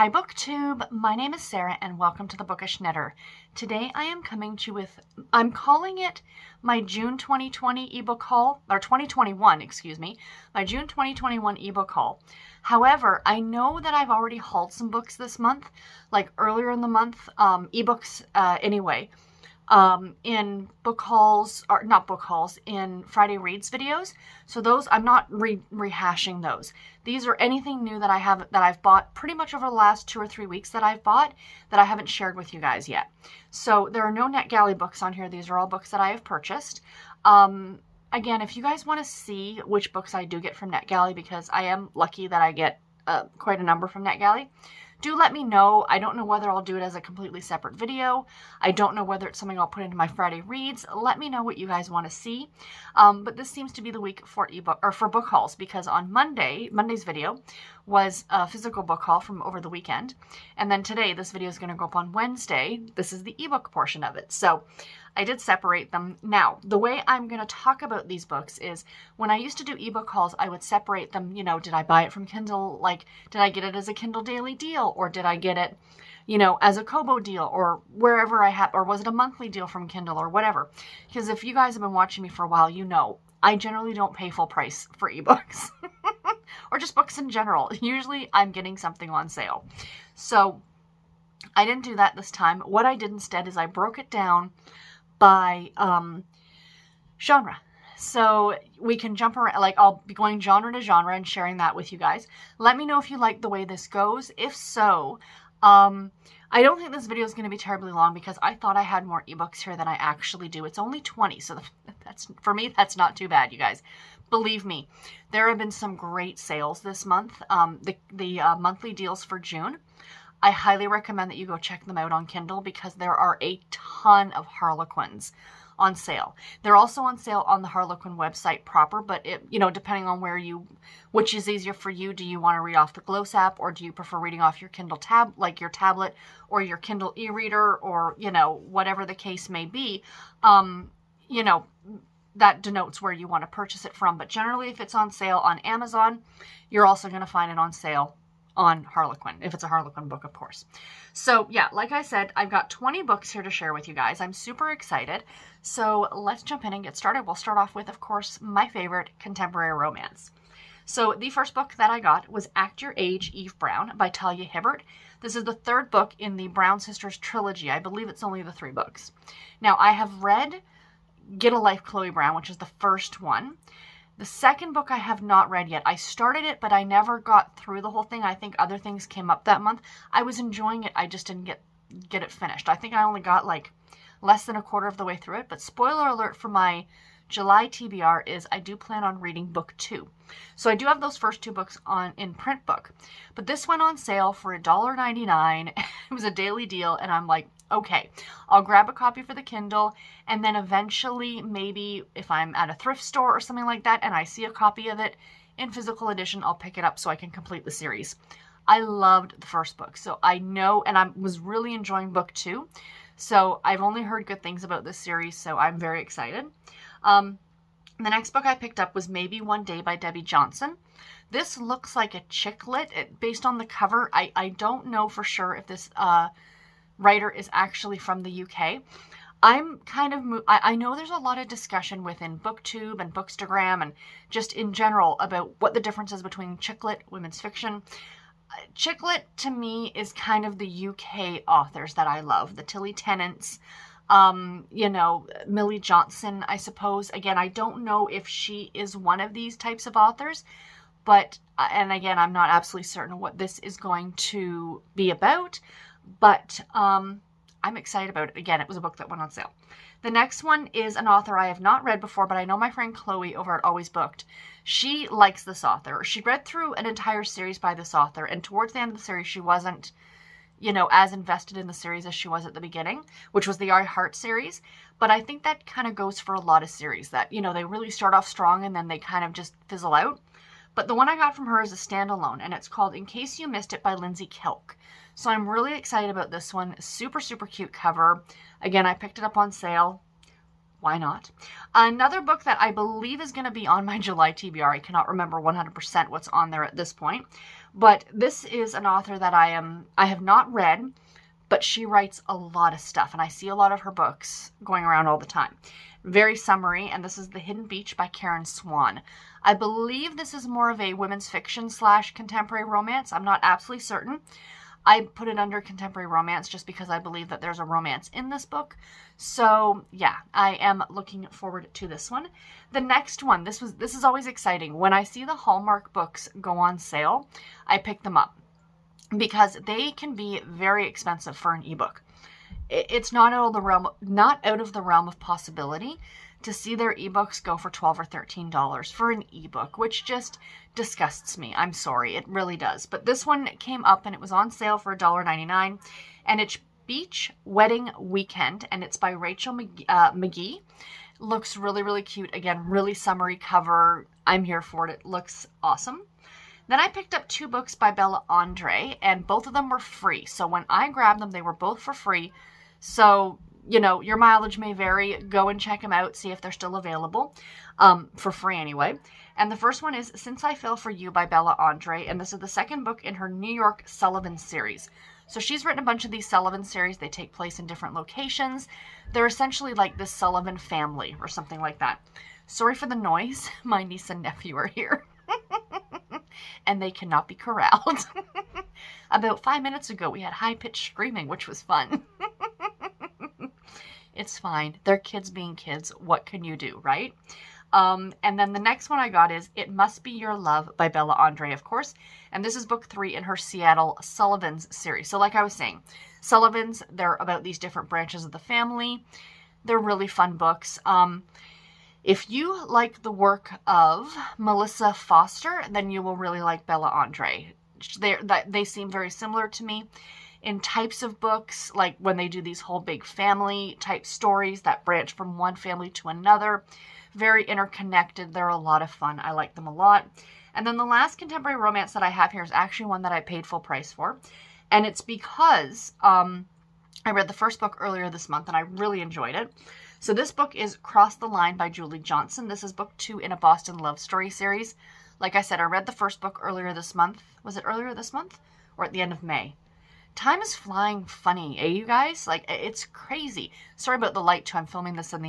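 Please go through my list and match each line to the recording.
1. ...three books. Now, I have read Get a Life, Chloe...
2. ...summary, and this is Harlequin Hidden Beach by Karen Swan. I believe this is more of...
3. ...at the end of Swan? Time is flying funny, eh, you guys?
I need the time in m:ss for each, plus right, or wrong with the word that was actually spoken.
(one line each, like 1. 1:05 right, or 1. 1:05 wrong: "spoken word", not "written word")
1. 2:48 right
2. 5:06 wrong: "The", not "Harlequin"
3. 7:28 wrong: "May", not "Swan".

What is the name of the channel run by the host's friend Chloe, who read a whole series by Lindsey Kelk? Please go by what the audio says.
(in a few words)
Always Booked.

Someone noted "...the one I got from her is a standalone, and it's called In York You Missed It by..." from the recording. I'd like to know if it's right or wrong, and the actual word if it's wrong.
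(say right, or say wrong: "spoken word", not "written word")
wrong: "Case", not "York".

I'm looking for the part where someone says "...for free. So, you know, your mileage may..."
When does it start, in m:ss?
6:01.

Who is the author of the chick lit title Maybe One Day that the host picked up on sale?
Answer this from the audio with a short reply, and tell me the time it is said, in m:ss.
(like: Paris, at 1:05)
Debbie Johnson, at 3:39.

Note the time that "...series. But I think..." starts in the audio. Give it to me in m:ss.
4:34.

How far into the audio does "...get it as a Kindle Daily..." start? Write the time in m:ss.
1:13.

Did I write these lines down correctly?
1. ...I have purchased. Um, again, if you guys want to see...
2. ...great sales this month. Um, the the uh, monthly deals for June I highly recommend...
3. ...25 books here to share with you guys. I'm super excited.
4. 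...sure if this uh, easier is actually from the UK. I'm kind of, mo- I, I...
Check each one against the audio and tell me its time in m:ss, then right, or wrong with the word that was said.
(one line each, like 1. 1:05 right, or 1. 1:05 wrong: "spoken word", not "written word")
1. 0:36 right
2. 1:55 right
3. 2:32 wrong: "20", not "25"
4. 3:45 wrong: "writer", not "easier".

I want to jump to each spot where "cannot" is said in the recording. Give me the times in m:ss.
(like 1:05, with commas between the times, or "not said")
4:54, 6:26.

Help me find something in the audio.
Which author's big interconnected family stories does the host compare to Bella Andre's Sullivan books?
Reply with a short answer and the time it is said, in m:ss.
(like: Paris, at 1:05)
Melissa Foster, at 6:54.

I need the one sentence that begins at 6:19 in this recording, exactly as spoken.
They're essentially like the Sullivan family or something like that.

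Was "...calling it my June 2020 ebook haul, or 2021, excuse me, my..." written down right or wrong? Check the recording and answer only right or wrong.
right.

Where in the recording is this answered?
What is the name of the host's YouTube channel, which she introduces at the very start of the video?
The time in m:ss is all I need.
0:02.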